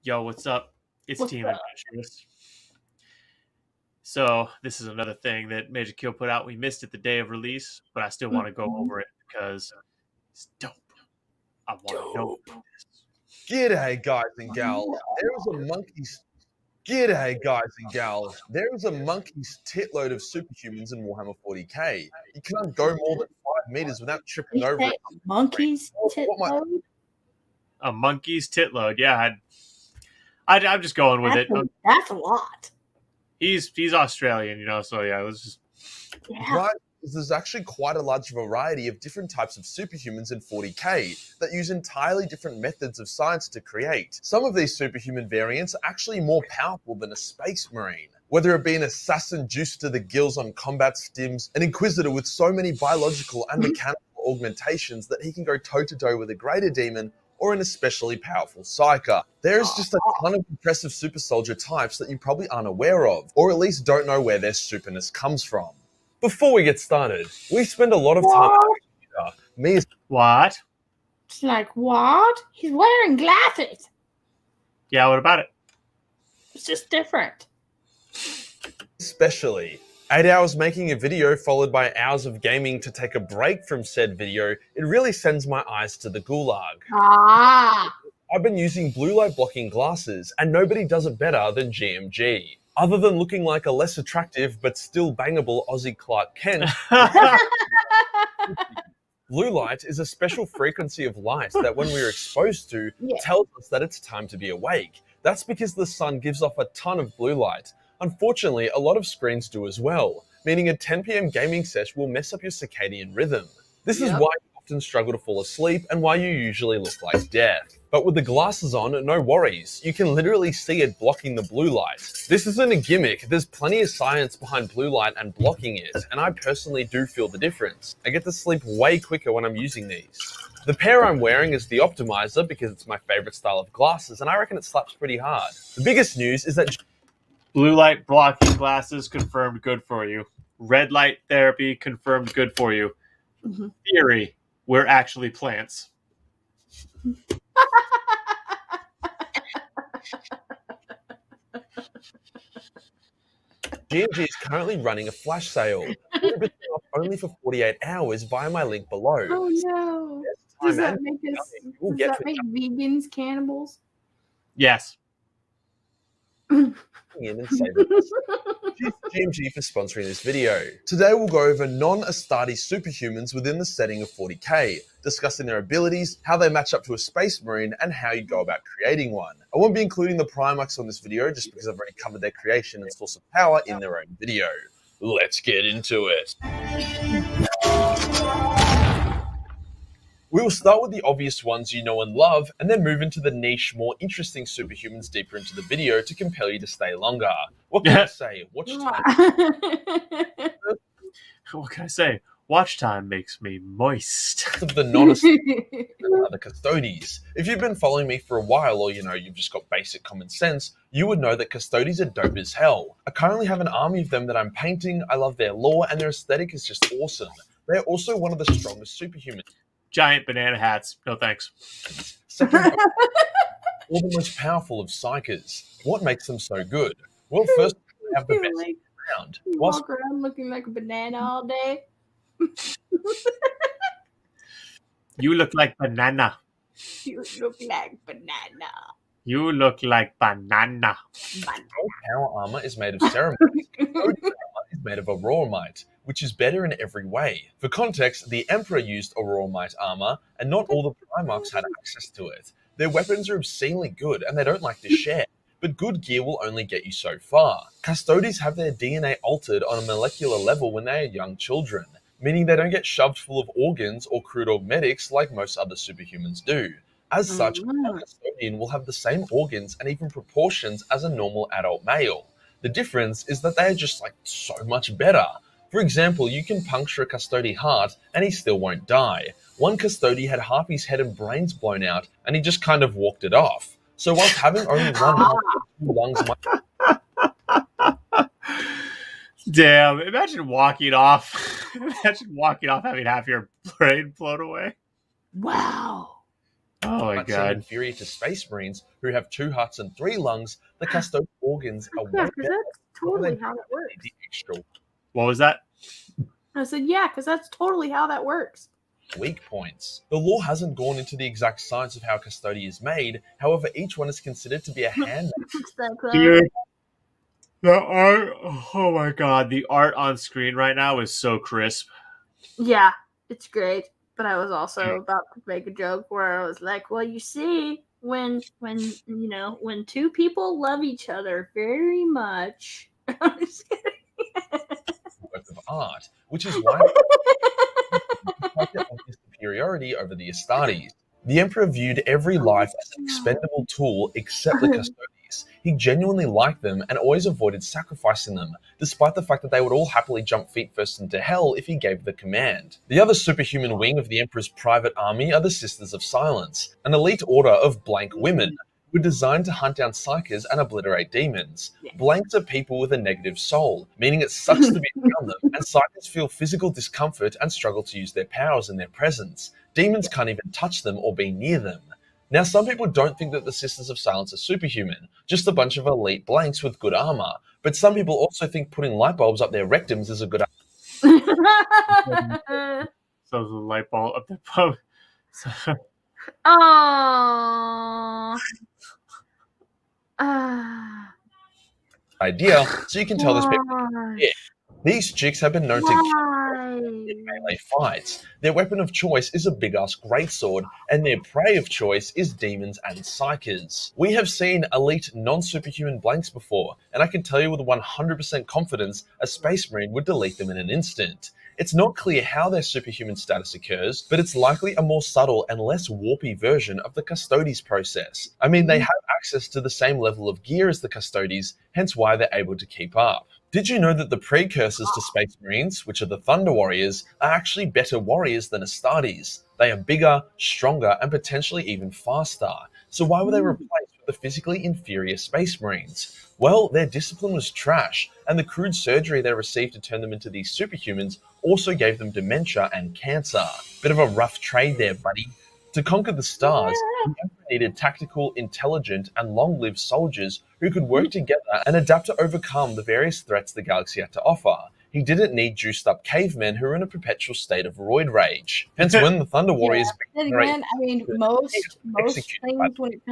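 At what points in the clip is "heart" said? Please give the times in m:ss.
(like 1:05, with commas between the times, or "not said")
4:37, 4:59, 5:35.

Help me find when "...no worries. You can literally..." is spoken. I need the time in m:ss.
1:59.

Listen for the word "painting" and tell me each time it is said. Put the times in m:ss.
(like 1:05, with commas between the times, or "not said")
3:34.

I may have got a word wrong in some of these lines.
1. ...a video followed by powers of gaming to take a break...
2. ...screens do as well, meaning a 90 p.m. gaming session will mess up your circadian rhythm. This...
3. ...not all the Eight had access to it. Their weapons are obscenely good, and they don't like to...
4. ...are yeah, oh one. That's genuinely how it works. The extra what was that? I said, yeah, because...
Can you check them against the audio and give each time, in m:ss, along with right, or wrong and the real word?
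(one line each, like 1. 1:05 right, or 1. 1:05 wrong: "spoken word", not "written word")
1. 1:20 wrong: "hours", not "powers"
2. 1:49 wrong: "10", not "90"
3. 4:10 wrong: "Primarchs", not "Eight"
4. 5:01 wrong: "totally", not "genuinely".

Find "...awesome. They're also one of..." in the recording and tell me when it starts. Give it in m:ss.
3:37.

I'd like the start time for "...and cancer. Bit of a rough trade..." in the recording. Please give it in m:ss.
7:22.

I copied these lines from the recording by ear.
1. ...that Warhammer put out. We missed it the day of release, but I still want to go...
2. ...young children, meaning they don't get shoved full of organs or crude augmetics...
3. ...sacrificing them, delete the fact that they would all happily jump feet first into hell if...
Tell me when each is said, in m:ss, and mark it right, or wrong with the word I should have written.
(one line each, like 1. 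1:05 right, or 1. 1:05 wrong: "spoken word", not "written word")
1. 0:05 wrong: "Majorkill", not "Warhammer"
2. 4:21 right
3. 5:47 wrong: "despite", not "delete".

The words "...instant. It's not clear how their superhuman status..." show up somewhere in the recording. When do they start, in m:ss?
6:50.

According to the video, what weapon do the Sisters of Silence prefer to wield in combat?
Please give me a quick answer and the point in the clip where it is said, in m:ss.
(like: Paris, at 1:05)
greatsword, at 6:39.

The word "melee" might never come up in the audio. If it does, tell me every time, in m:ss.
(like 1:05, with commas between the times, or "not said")
6:37.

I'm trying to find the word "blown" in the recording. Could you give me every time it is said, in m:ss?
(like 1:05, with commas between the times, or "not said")
4:41, 4:54.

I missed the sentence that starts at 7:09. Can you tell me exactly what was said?
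They are bigger, stronger, and potentially even faster.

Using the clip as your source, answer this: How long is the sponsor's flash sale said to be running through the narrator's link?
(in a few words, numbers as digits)
48 hours.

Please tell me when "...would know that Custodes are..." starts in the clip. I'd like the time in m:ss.
3:31.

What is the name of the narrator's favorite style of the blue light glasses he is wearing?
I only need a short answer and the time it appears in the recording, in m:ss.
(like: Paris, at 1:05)
Optimizer, at 2:11.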